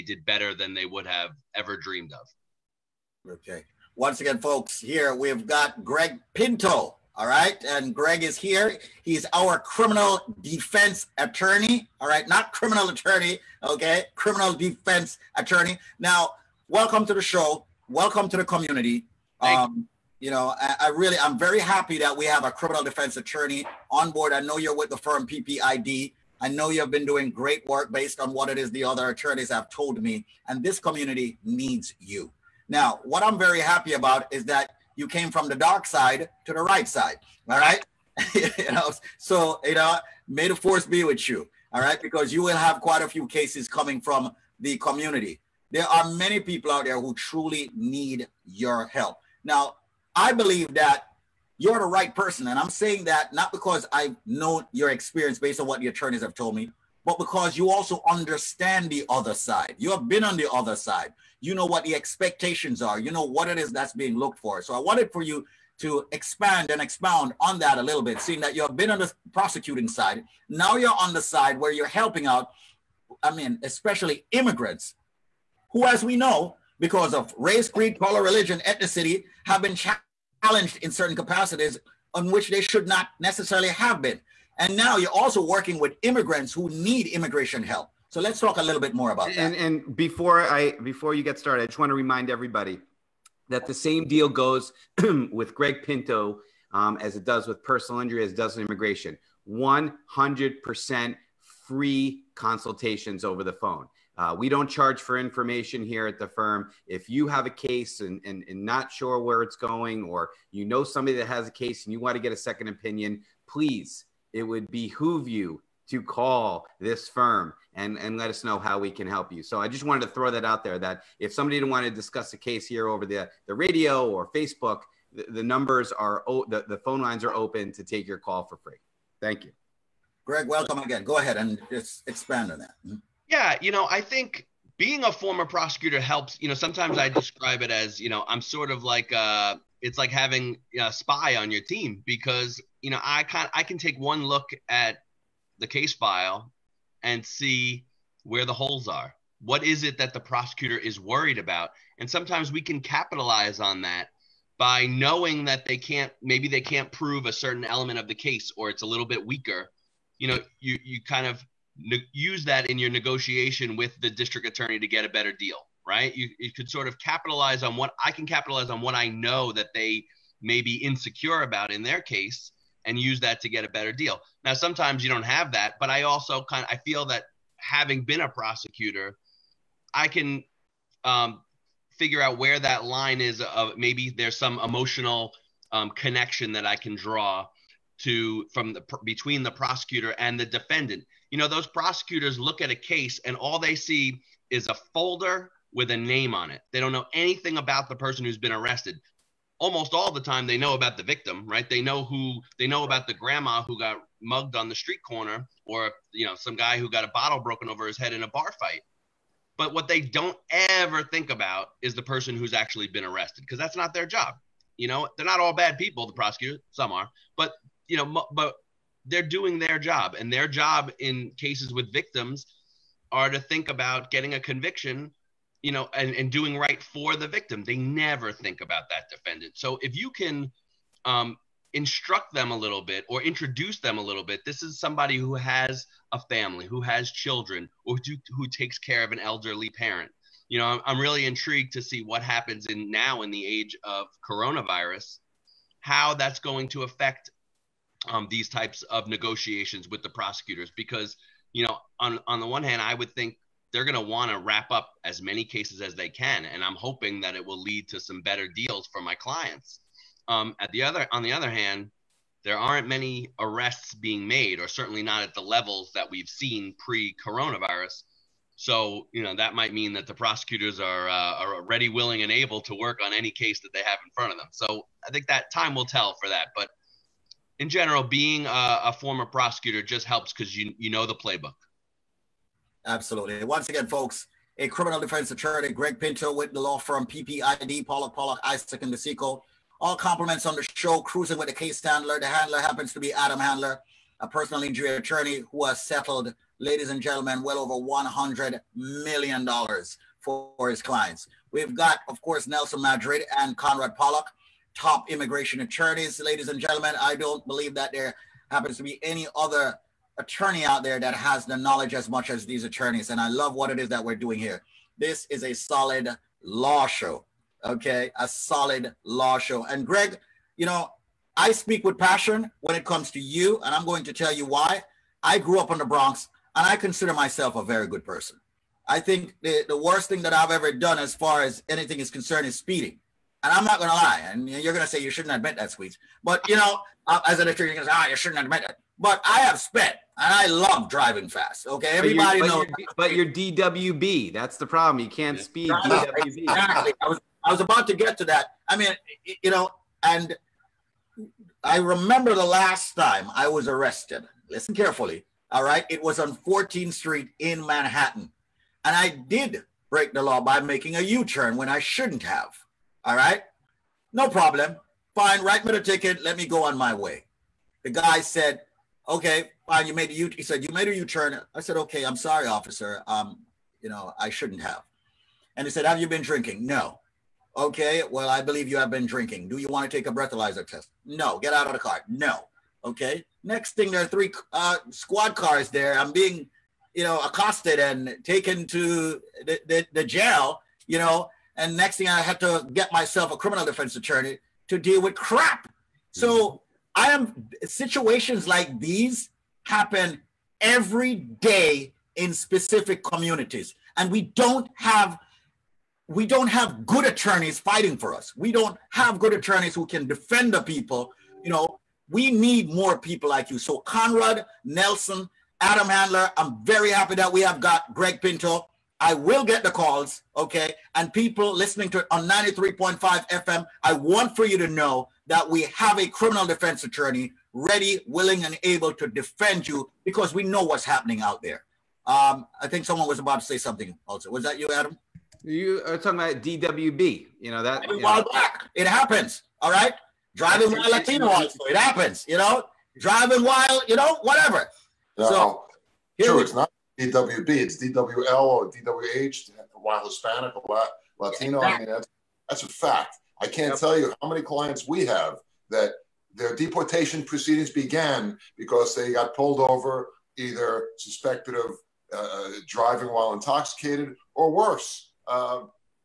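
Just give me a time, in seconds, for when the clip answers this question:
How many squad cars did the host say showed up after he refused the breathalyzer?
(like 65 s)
384 s.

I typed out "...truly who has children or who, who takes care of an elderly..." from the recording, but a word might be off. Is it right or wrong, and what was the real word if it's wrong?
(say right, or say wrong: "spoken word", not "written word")
wrong: "family", not "truly".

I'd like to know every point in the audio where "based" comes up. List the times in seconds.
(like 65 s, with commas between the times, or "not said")
27 s, 55 s.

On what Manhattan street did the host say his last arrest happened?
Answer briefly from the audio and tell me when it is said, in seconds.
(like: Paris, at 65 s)
14th Street, at 356 s.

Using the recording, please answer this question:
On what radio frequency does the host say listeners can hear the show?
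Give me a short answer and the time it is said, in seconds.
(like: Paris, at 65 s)
93.5 FM, at 422 s.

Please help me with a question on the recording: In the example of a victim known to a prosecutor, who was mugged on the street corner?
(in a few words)
grandma.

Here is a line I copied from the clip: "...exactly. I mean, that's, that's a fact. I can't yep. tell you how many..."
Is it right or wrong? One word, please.
right.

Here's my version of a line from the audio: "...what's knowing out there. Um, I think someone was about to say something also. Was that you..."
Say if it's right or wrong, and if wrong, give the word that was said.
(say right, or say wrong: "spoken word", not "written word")
wrong: "happening", not "knowing".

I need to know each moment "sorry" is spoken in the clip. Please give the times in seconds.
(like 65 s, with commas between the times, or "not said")
372 s.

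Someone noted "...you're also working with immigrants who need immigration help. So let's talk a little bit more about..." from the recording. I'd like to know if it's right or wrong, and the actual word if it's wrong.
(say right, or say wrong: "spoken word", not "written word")
right.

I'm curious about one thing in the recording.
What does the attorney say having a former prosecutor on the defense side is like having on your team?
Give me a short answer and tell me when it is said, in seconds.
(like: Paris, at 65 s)
a spy, at 140 s.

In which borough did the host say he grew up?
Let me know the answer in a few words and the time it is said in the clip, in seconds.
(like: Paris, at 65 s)
the Bronx, at 325 s.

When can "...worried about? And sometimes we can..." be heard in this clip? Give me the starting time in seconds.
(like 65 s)
150 s.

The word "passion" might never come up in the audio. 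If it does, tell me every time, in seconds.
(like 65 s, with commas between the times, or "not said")
321 s.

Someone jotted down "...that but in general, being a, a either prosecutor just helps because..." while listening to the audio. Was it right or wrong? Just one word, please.
wrong.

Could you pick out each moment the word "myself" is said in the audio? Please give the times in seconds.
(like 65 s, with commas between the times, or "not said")
327 s, 392 s.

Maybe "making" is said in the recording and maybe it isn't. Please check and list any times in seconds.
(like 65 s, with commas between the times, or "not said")
360 s.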